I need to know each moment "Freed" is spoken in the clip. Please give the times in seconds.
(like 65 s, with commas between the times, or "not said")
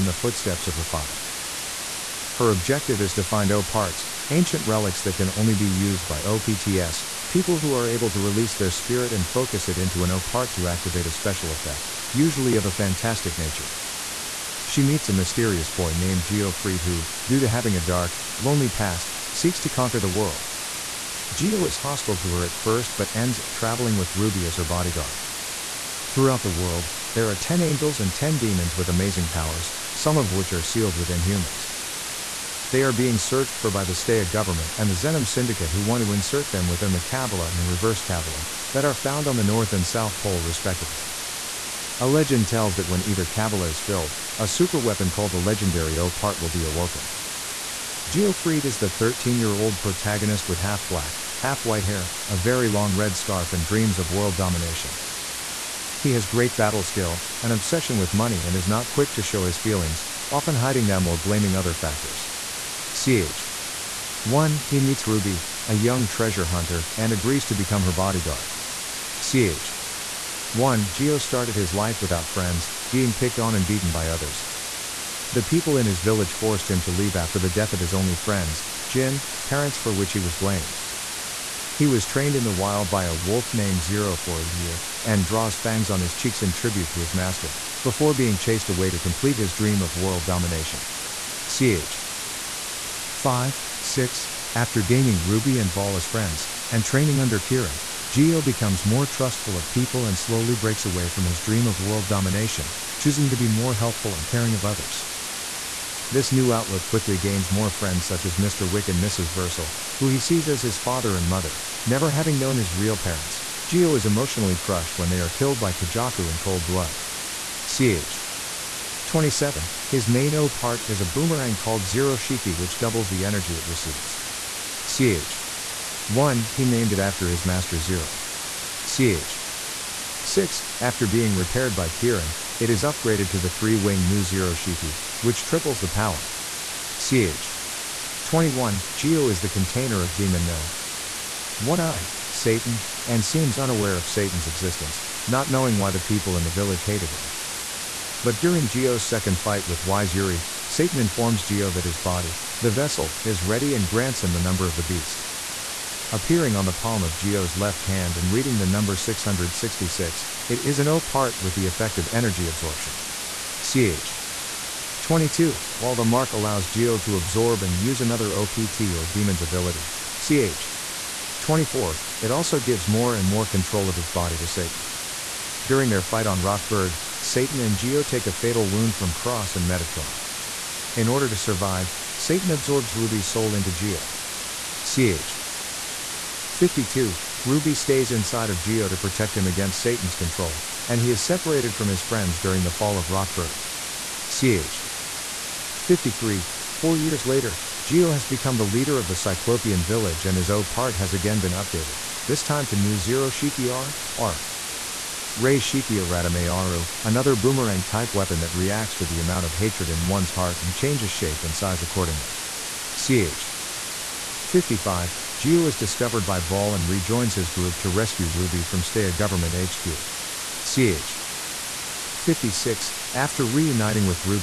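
16 s, 48 s.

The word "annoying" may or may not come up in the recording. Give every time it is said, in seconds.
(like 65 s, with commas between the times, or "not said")
not said.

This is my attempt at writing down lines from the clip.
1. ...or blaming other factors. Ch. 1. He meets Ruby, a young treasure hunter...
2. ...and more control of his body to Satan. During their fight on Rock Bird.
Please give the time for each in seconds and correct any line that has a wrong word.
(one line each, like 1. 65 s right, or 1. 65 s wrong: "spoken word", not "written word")
1. 61 s right
2. 173 s right.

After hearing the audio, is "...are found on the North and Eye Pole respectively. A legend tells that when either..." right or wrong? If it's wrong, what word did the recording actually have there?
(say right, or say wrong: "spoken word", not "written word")
wrong: "South", not "Eye".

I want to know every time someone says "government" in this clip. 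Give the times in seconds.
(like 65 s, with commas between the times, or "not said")
34 s, 219 s.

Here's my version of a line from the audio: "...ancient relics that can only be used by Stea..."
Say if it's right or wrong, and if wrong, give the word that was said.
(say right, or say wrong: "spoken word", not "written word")
wrong: "OPTS", not "Stea".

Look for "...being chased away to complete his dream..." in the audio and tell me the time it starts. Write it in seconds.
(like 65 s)
88 s.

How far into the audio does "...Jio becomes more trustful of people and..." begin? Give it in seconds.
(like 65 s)
98 s.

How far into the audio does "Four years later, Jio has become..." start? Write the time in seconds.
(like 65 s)
196 s.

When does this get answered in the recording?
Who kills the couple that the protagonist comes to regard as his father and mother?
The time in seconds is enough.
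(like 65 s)
115 s.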